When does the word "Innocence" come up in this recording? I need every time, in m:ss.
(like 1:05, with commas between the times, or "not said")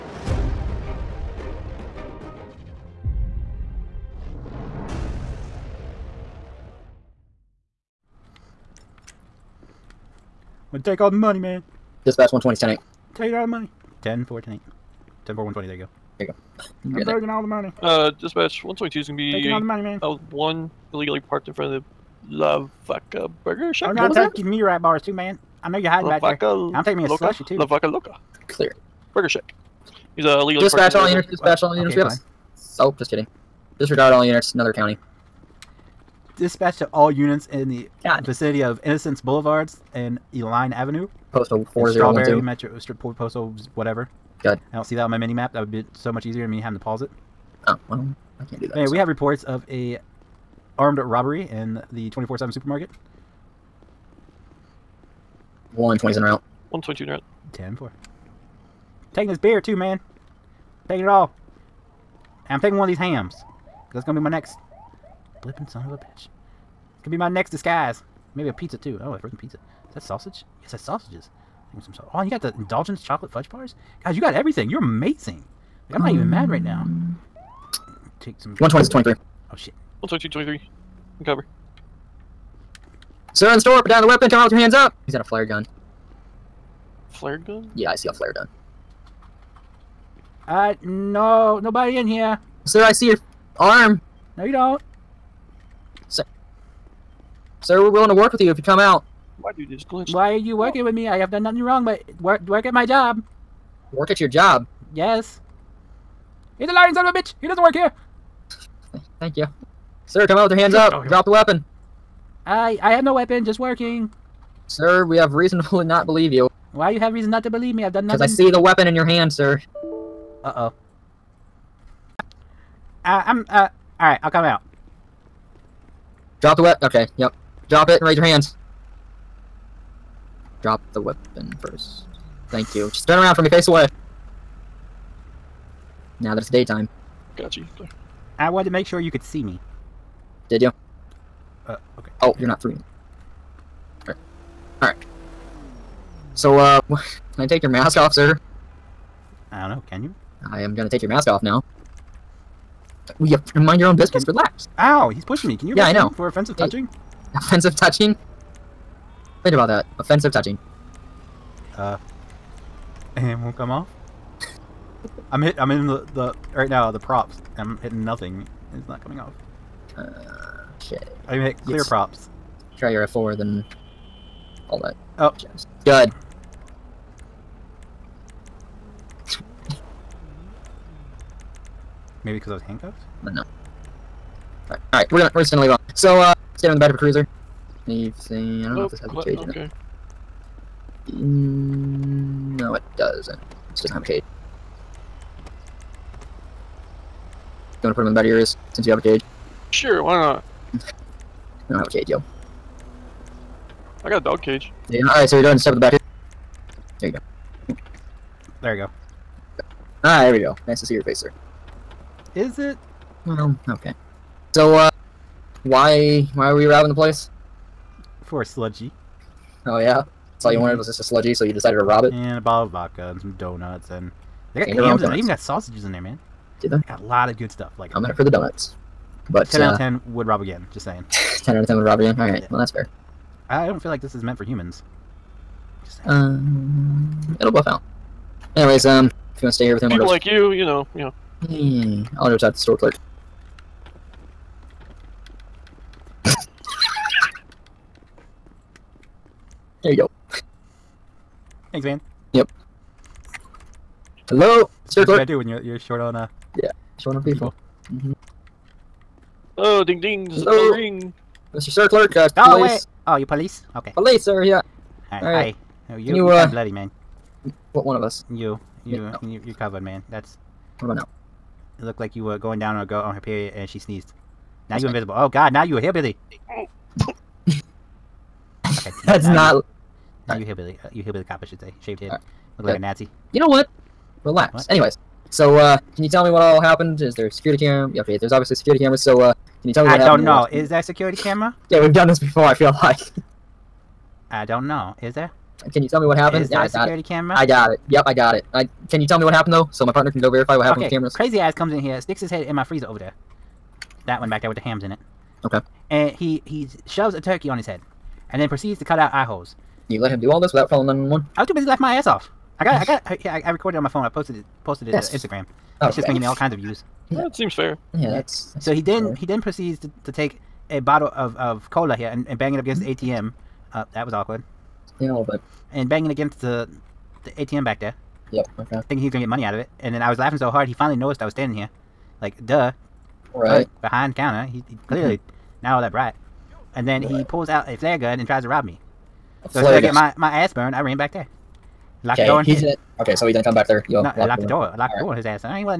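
0:38.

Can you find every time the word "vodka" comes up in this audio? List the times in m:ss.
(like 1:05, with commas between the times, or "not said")
3:42.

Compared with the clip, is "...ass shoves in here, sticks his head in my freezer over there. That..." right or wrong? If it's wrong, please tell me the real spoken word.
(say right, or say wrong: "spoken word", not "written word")
wrong: "comes", not "shoves".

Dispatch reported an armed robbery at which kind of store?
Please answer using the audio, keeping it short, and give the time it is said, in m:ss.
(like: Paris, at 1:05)
24/7 supermarket, at 0:52.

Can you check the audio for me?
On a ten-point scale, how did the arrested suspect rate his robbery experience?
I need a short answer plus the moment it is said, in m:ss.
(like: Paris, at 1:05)
10 out of 10, at 3:51.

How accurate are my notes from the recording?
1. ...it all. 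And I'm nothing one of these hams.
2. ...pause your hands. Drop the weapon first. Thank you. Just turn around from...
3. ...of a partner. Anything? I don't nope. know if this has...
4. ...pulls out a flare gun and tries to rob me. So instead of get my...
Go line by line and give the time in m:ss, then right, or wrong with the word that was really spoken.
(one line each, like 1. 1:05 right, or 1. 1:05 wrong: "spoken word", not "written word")
1. 1:01 wrong: "taking", not "nothing"
2. 2:08 wrong: "raise", not "pause"
3. 3:06 wrong: "cruiser", not "partner"
4. 5:37 right.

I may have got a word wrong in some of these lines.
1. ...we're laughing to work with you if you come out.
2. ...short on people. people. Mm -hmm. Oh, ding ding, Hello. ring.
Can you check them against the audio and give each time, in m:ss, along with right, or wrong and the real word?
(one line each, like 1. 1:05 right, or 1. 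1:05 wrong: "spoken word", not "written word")
1. 1:37 wrong: "willing", not "laughing"
2. 4:16 right.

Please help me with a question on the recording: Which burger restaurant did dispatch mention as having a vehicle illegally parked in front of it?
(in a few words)
La Vaca Burger Shop.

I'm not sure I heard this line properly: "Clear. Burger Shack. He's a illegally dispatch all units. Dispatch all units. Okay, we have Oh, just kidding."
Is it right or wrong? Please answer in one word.
right.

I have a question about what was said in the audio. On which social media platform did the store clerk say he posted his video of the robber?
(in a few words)
Instagram.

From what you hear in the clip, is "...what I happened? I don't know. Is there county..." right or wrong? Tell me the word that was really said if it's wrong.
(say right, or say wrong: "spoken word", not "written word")
wrong: "security", not "county".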